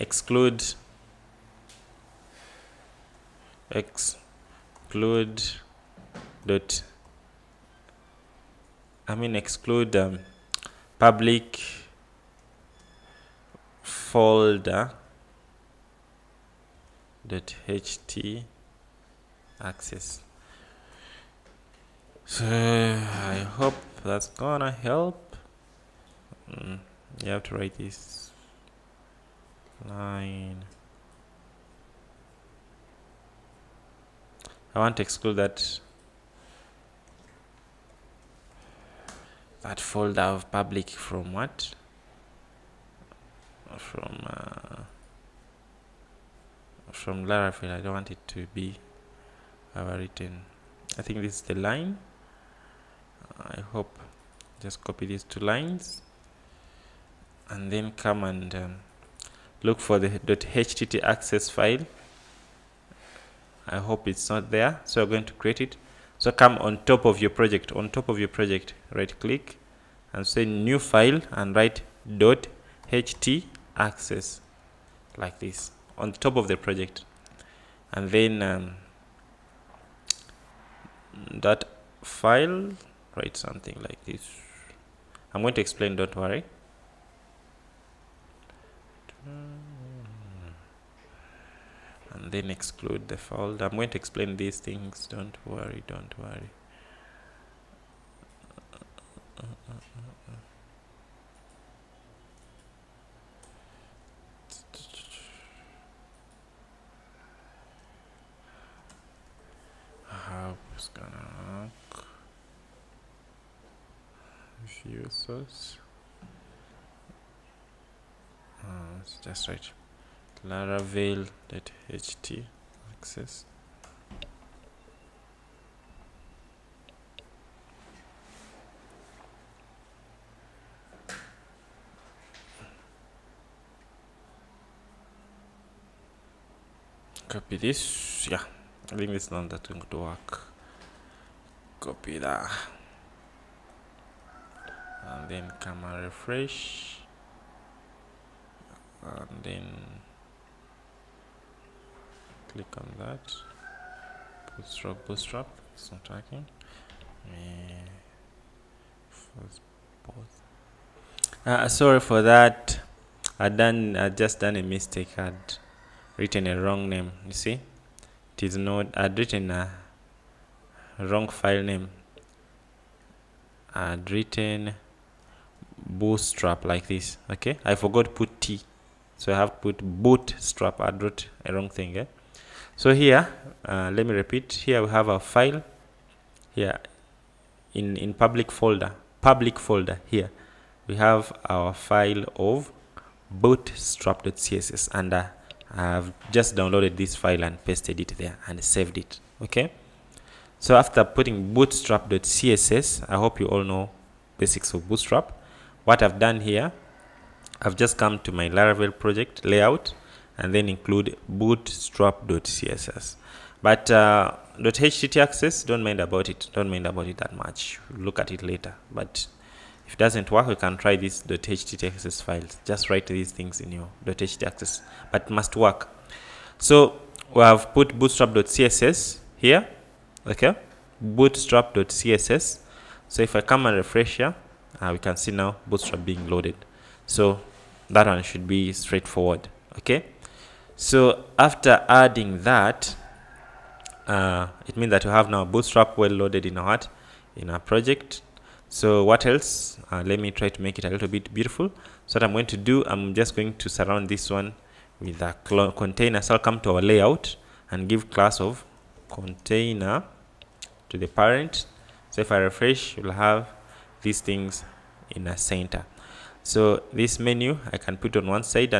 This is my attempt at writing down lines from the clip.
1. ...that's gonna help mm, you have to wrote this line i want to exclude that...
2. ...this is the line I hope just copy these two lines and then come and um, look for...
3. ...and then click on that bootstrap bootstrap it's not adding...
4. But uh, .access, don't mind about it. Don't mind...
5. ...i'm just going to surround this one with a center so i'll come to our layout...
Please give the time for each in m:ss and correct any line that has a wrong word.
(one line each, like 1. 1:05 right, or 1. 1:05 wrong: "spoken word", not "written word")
1. 0:24 wrong: "write", not "wrote"
2. 0:51 right
3. 2:29 wrong: "working", not "adding"
4. 3:33 wrong: "htaccess", not "access"
5. 4:12 wrong: "container", not "center".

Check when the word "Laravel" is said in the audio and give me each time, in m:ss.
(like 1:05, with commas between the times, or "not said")
0:47, 3:28.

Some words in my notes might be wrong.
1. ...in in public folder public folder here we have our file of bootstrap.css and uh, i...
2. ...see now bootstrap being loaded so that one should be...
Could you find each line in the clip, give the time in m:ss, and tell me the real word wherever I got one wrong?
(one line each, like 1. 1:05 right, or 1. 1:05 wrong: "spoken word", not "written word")
1. 3:07 right
2. 3:55 right.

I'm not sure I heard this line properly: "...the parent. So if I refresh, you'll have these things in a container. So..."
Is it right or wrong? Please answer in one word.
wrong.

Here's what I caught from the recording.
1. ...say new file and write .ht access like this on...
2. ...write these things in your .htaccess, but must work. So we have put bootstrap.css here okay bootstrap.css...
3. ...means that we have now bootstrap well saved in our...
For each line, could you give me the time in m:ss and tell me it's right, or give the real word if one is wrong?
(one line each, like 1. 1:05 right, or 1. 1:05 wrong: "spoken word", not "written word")
1. 1:10 right
2. 3:42 right
3. 4:04 wrong: "loaded", not "saved".